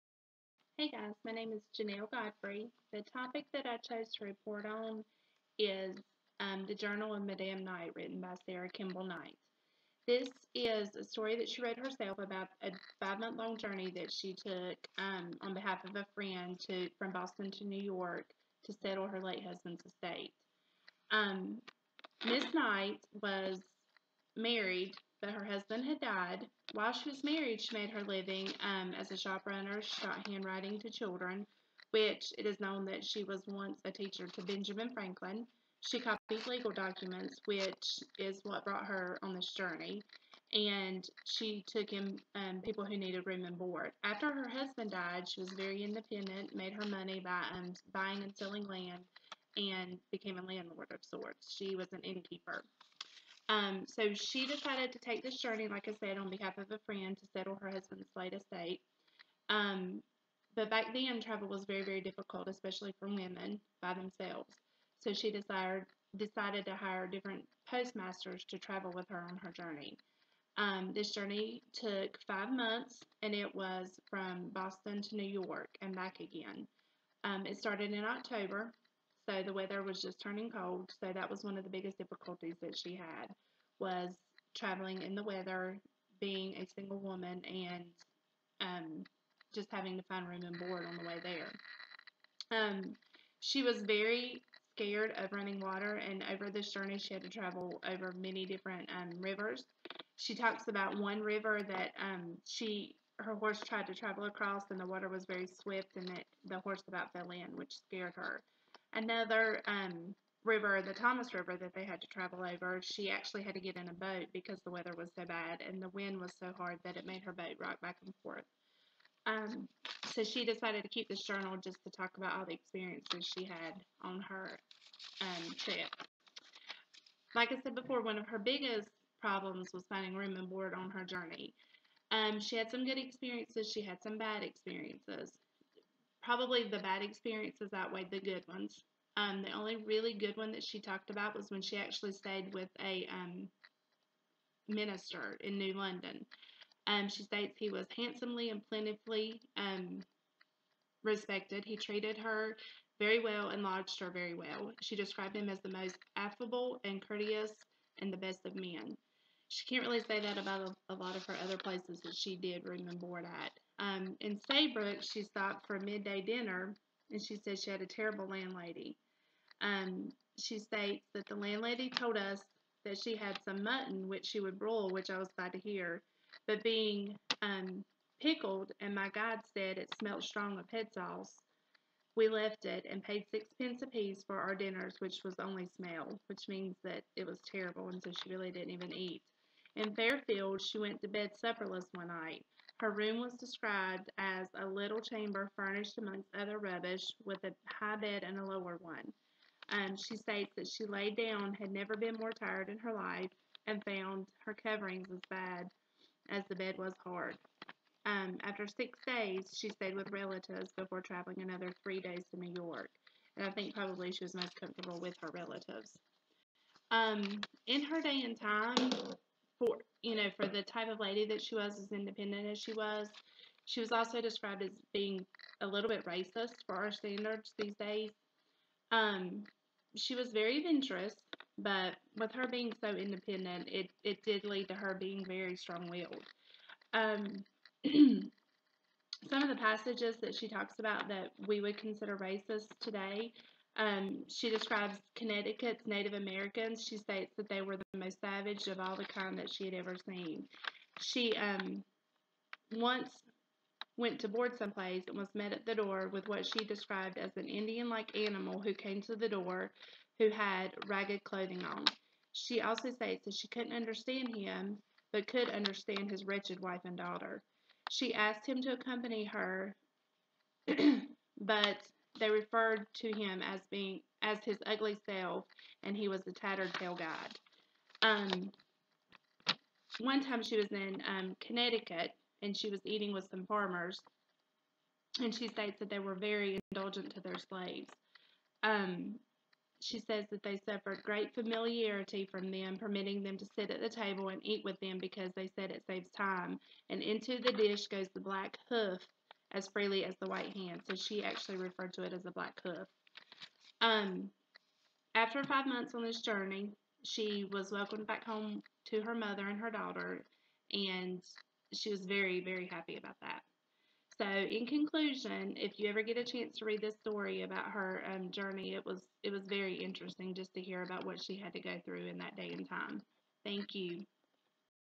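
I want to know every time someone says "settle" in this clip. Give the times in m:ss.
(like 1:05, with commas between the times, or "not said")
0:18, 0:57.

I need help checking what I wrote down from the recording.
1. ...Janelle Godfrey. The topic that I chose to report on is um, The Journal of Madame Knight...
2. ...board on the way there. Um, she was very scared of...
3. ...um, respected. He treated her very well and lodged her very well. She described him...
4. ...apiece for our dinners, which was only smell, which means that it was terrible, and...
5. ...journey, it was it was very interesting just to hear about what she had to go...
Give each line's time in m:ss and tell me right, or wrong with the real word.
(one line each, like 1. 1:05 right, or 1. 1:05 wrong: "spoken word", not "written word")
1. 0:01 right
2. 1:30 right
3. 2:29 right
4. 3:03 right
5. 5:18 right.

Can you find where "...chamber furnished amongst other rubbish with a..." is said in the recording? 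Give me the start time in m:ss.
3:15.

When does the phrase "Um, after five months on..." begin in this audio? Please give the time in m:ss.
5:03.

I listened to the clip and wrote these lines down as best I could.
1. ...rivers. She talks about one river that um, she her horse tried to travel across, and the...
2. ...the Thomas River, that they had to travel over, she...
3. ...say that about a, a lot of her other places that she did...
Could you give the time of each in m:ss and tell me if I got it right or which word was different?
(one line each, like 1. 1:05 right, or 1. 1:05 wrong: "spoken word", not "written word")
1. 1:39 right
2. 1:50 right
3. 2:40 right.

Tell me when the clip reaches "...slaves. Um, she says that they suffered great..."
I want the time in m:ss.
4:47.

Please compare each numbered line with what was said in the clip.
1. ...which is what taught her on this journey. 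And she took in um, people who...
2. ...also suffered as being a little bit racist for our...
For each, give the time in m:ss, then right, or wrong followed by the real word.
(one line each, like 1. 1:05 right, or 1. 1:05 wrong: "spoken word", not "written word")
1. 0:37 wrong: "brought", not "taught"
2. 3:43 wrong: "described", not "suffered".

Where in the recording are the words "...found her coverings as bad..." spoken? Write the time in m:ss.
3:23.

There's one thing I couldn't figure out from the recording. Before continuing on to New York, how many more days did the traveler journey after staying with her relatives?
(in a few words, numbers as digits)
3.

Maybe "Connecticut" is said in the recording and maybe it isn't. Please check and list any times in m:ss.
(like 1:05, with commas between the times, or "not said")
4:05, 4:41.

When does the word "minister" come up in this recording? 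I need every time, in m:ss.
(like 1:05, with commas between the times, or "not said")
2:24.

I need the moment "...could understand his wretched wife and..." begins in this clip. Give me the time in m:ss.
4:25.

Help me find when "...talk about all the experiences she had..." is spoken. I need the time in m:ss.
2:01.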